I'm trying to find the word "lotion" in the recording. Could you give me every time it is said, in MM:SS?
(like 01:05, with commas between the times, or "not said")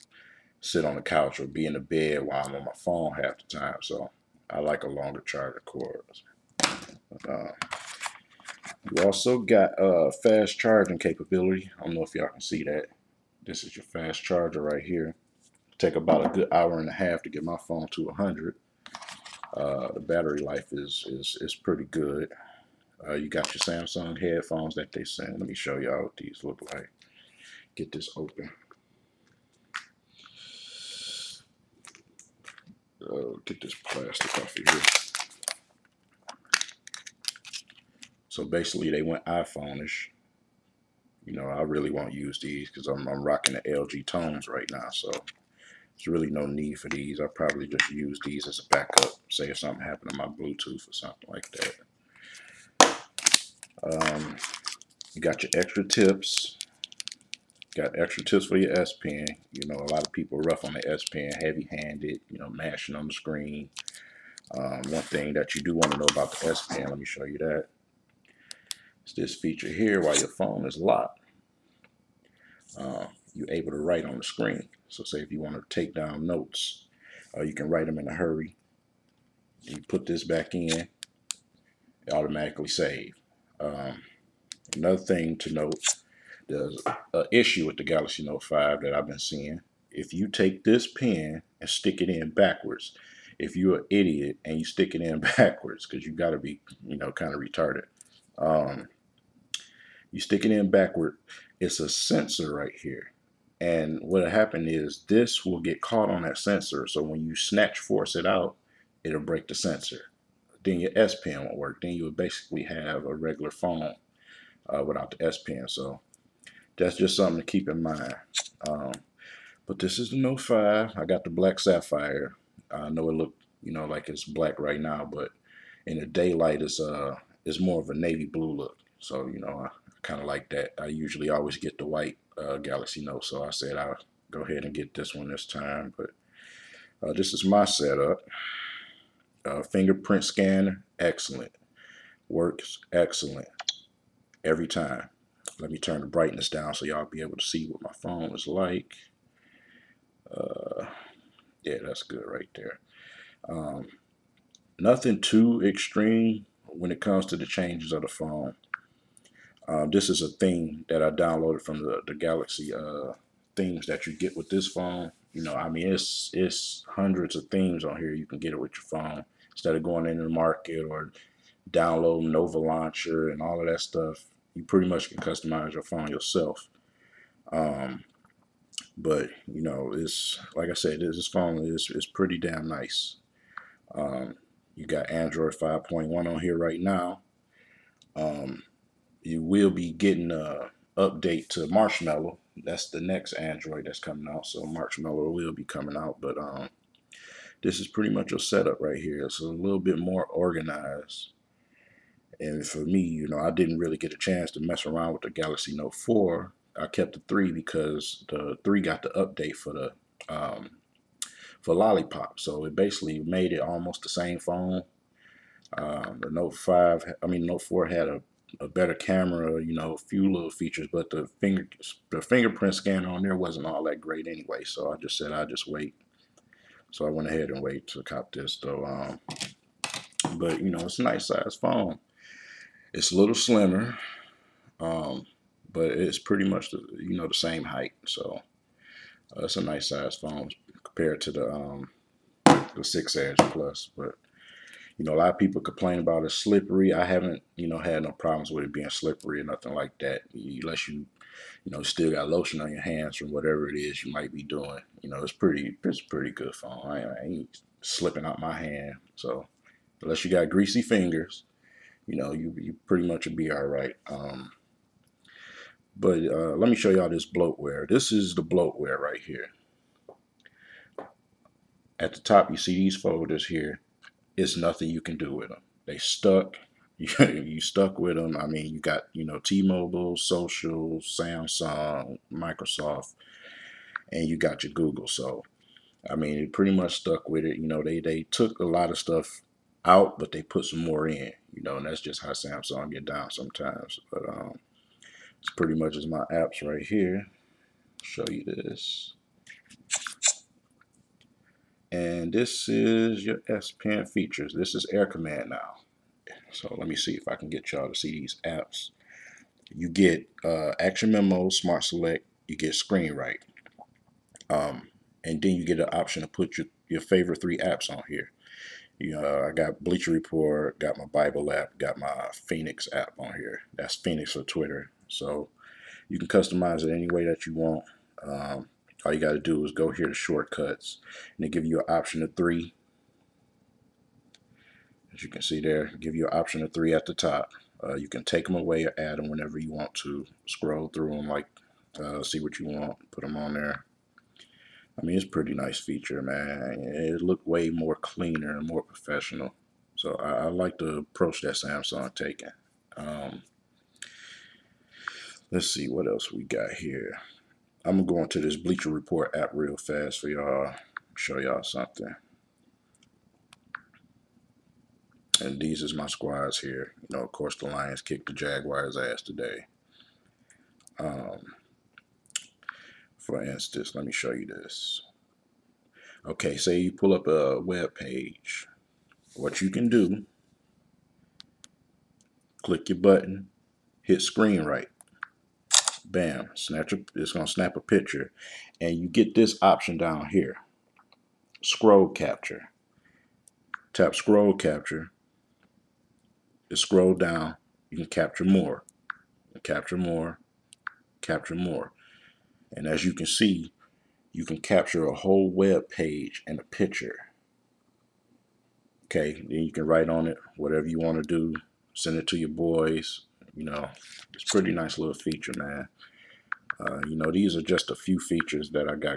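04:12.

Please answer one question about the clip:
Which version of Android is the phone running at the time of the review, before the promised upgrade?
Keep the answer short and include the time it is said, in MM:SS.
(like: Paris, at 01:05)
5.1, at 03:05.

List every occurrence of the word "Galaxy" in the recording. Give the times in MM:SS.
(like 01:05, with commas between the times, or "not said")
01:27, 02:12, 02:42, 03:25.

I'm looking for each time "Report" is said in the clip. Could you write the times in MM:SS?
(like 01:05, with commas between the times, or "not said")
05:20, 05:58.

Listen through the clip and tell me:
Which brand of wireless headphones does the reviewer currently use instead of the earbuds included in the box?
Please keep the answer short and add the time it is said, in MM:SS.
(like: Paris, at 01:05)
LG Tones, at 00:43.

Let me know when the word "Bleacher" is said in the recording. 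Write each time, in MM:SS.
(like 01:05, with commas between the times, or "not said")
05:19, 05:58.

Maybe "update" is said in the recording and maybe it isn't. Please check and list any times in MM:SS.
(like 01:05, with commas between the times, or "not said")
03:10, 03:29.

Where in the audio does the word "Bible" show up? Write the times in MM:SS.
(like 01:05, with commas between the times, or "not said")
05:21.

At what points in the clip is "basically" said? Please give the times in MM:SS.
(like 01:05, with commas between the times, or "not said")
00:38, 01:52, 03:32.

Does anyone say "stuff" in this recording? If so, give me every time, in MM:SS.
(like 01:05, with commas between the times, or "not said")
02:53, 04:48.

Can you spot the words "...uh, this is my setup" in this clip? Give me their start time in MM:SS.
02:17.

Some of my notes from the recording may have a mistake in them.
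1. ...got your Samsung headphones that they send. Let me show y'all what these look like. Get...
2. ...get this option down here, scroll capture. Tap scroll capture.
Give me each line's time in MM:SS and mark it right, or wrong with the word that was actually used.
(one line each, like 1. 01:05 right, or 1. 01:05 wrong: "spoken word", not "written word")
1. 00:23 right
2. 06:29 right.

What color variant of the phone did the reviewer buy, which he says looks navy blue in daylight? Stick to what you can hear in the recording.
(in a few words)
Black Sapphire.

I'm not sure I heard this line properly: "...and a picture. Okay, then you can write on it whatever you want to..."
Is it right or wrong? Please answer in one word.
right.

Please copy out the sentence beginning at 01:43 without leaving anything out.
And what happened is this will get caught on that sensor.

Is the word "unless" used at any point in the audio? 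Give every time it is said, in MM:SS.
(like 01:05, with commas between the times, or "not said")
04:10, 04:20.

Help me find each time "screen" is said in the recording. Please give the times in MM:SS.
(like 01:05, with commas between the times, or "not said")
01:03, 01:14, 05:12, 06:24.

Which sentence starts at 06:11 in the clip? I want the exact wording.
Um, for instance, let me show you this.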